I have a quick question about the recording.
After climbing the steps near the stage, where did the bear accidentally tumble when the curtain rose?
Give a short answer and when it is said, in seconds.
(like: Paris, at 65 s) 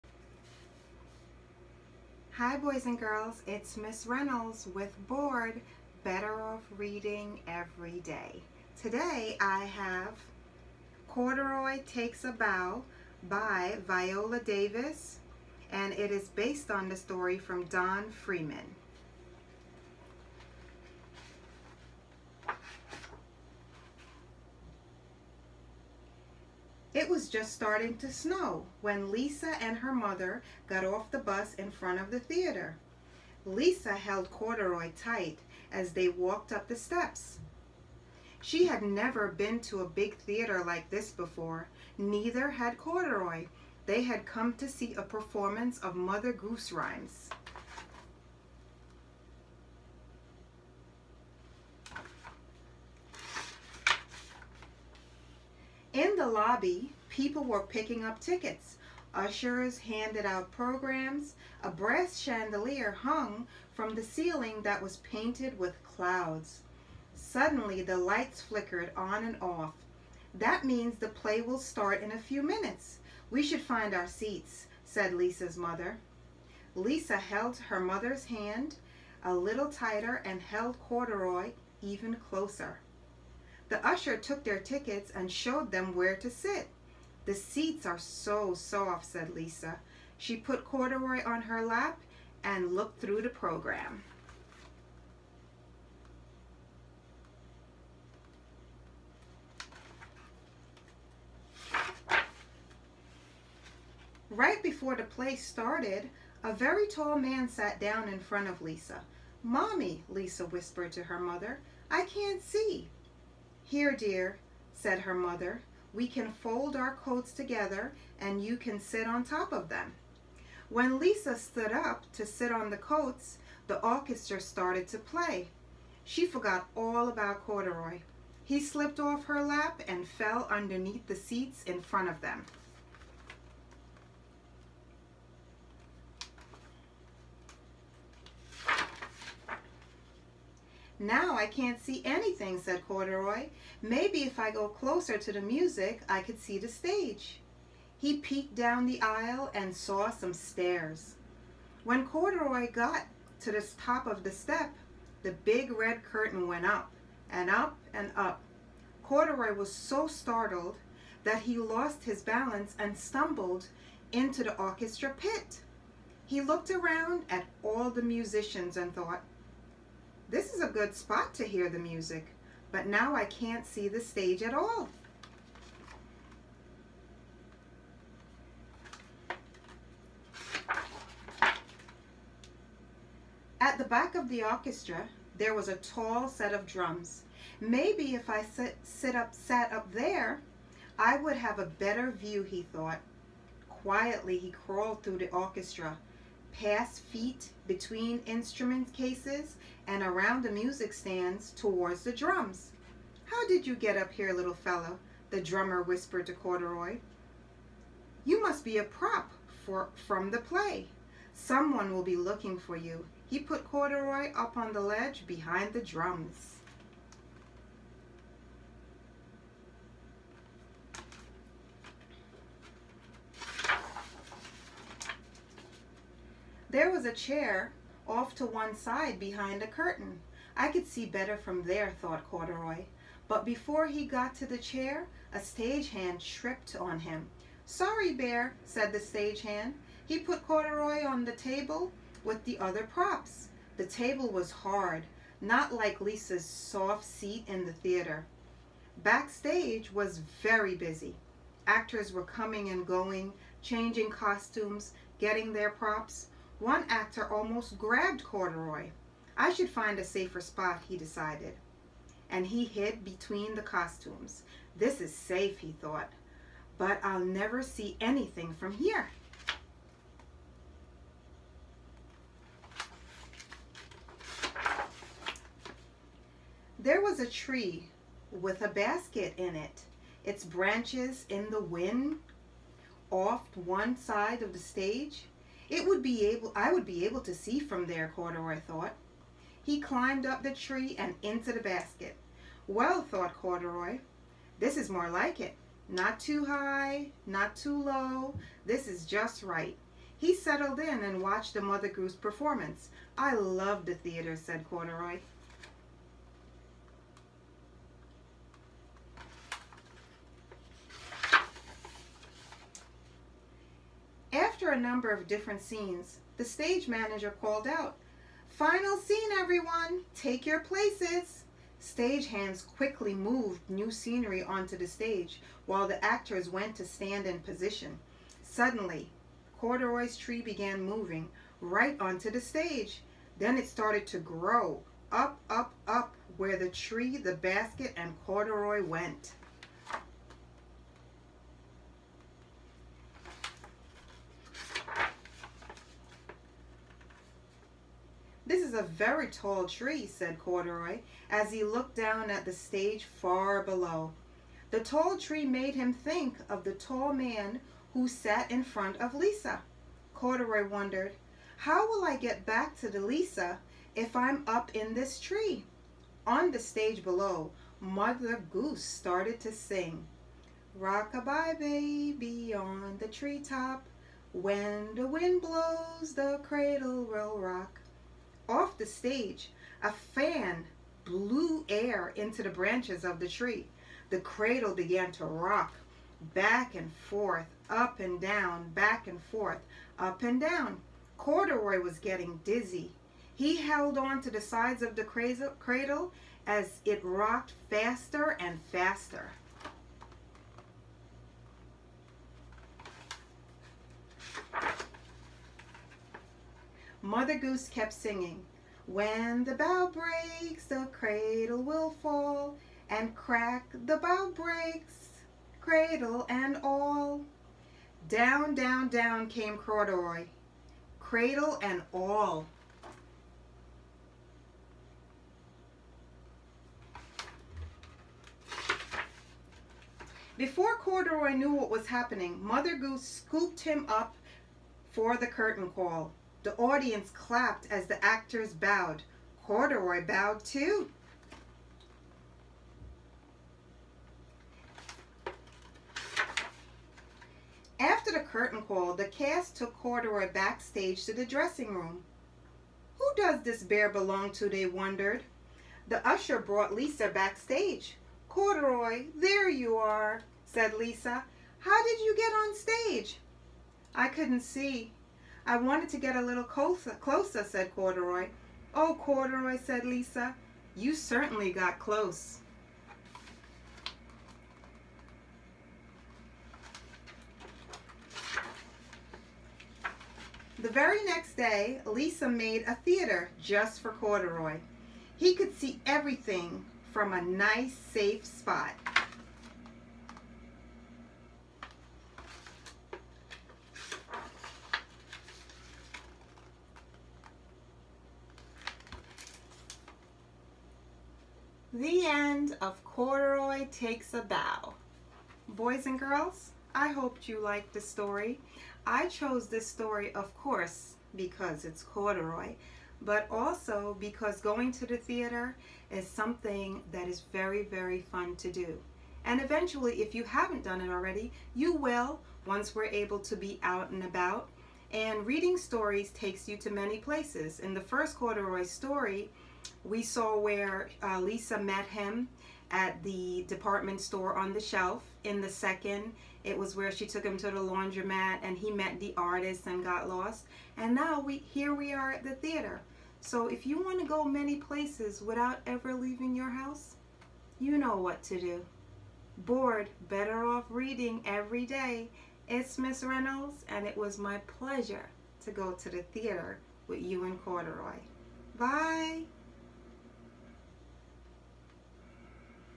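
The orchestra pit, at 164 s.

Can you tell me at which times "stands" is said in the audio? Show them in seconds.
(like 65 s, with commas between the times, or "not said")
200 s, 326 s.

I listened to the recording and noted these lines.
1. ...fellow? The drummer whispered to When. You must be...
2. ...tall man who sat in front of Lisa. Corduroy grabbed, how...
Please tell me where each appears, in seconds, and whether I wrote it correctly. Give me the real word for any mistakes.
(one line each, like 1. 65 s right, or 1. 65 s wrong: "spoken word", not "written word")
1. 204 s wrong: "Corduroy", not "When"
2. 356 s wrong: "wondered", not "grabbed".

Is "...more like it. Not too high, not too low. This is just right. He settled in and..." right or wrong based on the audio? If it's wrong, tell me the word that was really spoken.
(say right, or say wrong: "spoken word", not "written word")
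right.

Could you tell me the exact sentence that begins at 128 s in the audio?
He slipped off her lap and fell underneath the seats in front of them.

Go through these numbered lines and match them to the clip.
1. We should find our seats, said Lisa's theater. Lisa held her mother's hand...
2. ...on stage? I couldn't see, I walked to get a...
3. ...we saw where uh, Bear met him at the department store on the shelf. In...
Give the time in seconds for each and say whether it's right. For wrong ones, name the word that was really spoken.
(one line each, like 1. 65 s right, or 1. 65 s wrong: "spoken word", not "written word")
1. 73 s wrong: "mother", not "theater"
2. 462 s wrong: "wanted", not "walked"
3. 529 s wrong: "Lisa", not "Bear".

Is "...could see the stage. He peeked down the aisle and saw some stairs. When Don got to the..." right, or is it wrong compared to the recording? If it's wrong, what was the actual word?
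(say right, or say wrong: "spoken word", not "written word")
wrong: "Corduroy", not "Don".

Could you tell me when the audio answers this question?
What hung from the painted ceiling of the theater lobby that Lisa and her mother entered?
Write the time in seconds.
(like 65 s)
61 s.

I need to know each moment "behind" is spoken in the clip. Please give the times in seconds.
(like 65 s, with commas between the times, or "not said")
215 s, 229 s.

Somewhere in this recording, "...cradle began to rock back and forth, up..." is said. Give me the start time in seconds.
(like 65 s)
384 s.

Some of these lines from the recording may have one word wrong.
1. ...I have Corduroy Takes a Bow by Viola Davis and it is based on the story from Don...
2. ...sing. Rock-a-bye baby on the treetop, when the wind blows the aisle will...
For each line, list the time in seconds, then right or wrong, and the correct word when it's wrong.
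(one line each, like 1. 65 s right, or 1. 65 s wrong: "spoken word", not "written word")
1. 9 s right
2. 369 s wrong: "cradle", not "aisle".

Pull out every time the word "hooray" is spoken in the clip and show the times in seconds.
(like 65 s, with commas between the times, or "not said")
not said.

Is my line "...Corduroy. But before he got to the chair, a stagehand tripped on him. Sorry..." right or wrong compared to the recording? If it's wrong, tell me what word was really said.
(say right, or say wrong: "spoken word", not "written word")
right.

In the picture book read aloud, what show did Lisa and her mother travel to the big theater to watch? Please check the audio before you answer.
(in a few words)
Mother Goose Rhymes.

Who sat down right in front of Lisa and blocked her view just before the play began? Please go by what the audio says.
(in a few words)
A very tall man.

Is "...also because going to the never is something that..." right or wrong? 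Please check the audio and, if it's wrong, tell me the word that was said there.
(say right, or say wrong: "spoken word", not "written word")
wrong: "theater", not "never".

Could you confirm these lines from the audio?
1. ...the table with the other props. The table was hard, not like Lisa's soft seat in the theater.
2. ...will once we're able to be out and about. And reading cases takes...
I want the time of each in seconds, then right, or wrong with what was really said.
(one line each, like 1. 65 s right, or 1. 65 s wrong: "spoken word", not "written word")
1. 241 s right
2. 521 s wrong: "stories", not "cases".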